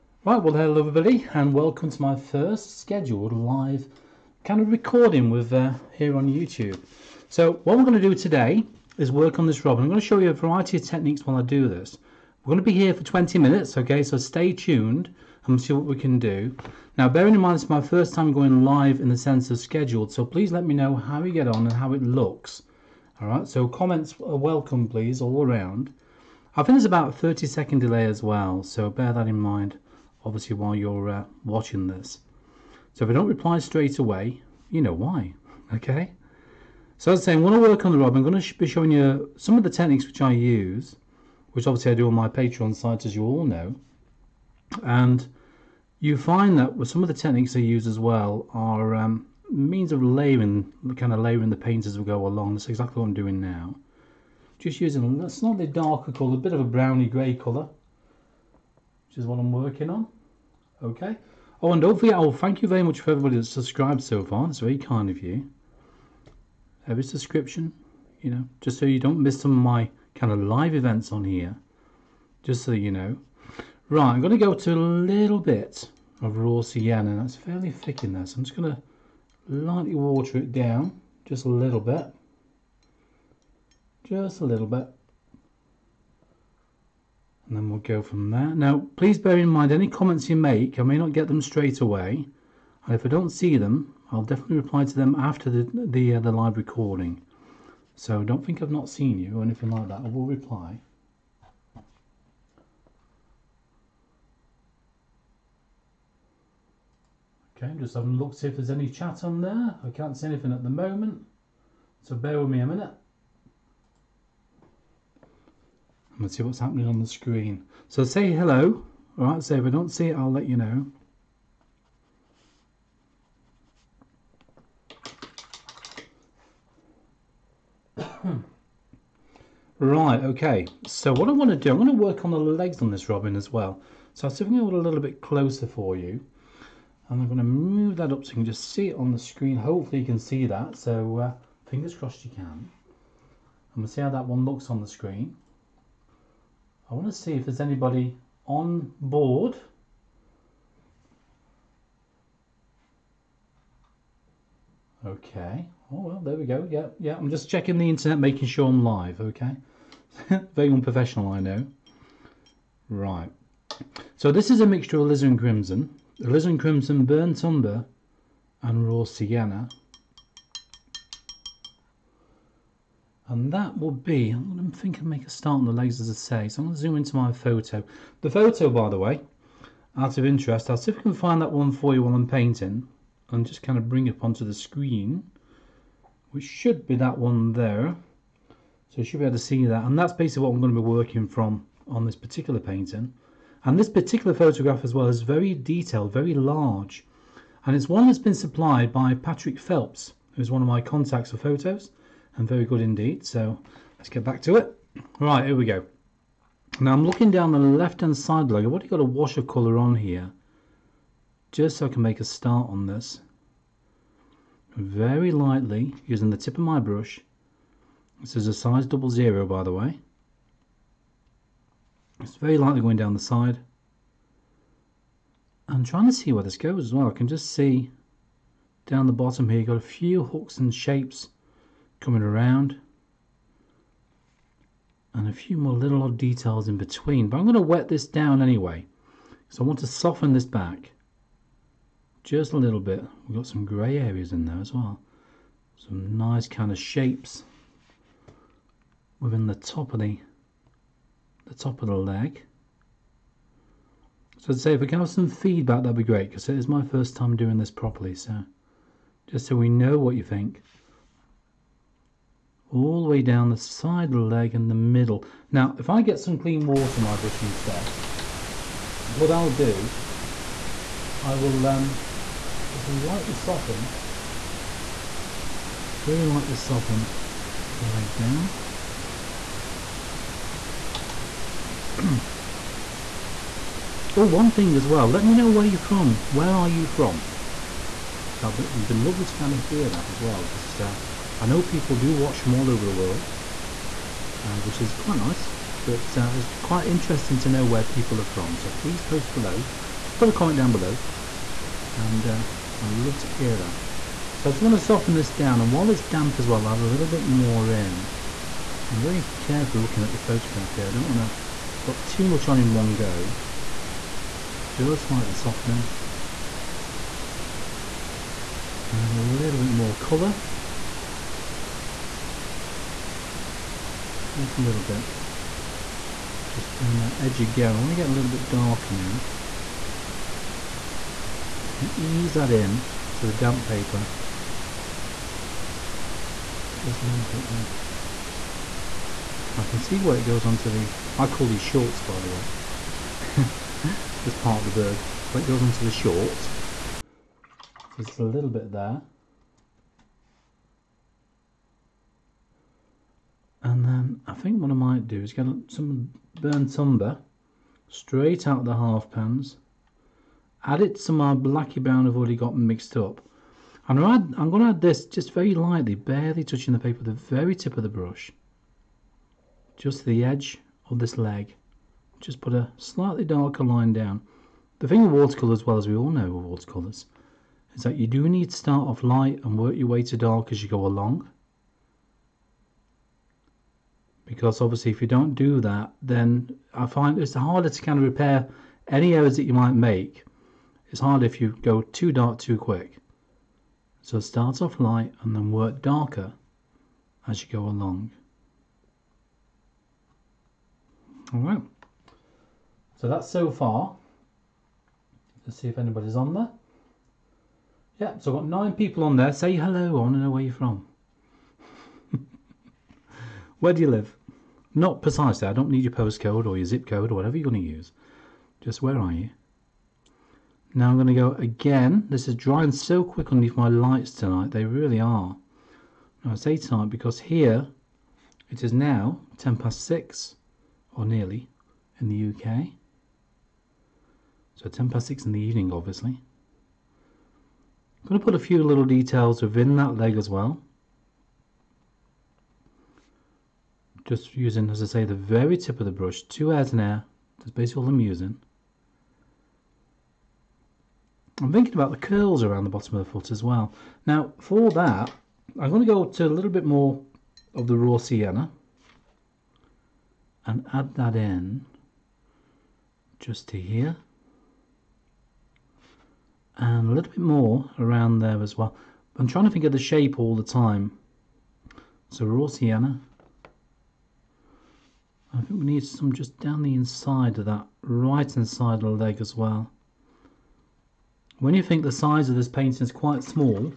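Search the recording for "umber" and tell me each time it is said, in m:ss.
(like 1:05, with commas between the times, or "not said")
2:47, 5:56.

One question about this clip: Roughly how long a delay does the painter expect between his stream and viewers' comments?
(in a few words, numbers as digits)
30 seconds.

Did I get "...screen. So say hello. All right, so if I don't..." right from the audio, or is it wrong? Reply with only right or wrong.
right.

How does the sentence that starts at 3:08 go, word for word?
So you should be able to see that.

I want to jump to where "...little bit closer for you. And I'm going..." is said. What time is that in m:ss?
2:14.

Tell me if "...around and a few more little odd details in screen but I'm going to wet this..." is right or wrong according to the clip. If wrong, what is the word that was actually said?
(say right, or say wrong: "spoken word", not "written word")
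wrong: "between", not "screen".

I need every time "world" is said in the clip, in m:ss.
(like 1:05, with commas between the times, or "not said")
4:52.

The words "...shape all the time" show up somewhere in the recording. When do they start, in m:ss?
7:49.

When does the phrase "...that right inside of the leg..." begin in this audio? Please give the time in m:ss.
7:57.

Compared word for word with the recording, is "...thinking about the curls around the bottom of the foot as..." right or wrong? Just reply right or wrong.
right.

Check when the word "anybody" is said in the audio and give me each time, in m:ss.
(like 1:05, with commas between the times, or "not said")
2:27, 6:45.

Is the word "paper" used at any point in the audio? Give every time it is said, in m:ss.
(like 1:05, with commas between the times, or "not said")
5:33, 6:06.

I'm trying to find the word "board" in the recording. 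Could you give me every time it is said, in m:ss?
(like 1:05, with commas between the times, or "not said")
2:28.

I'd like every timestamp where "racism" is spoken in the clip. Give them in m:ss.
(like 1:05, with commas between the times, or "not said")
not said.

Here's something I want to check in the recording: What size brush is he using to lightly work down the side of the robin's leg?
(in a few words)
Double zero.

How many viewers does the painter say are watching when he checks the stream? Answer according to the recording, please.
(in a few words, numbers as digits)
9.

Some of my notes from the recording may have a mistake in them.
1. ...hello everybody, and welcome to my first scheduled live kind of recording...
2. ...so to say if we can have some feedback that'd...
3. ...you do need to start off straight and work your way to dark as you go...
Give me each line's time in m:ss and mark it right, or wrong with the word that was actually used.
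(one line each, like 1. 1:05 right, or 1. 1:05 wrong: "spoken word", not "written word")
1. 0:00 right
2. 4:14 right
3. 6:17 wrong: "light", not "straight".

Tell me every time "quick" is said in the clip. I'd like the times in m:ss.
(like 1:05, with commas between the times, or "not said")
6:32, 7:03.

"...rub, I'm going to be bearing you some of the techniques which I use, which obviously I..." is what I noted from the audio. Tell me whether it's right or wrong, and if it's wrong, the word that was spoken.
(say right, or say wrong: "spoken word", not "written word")
wrong: "showing", not "bearing".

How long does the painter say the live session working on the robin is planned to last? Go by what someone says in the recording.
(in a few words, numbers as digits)
20 minutes.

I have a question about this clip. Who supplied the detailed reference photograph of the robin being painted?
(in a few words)
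Patrick Phelps.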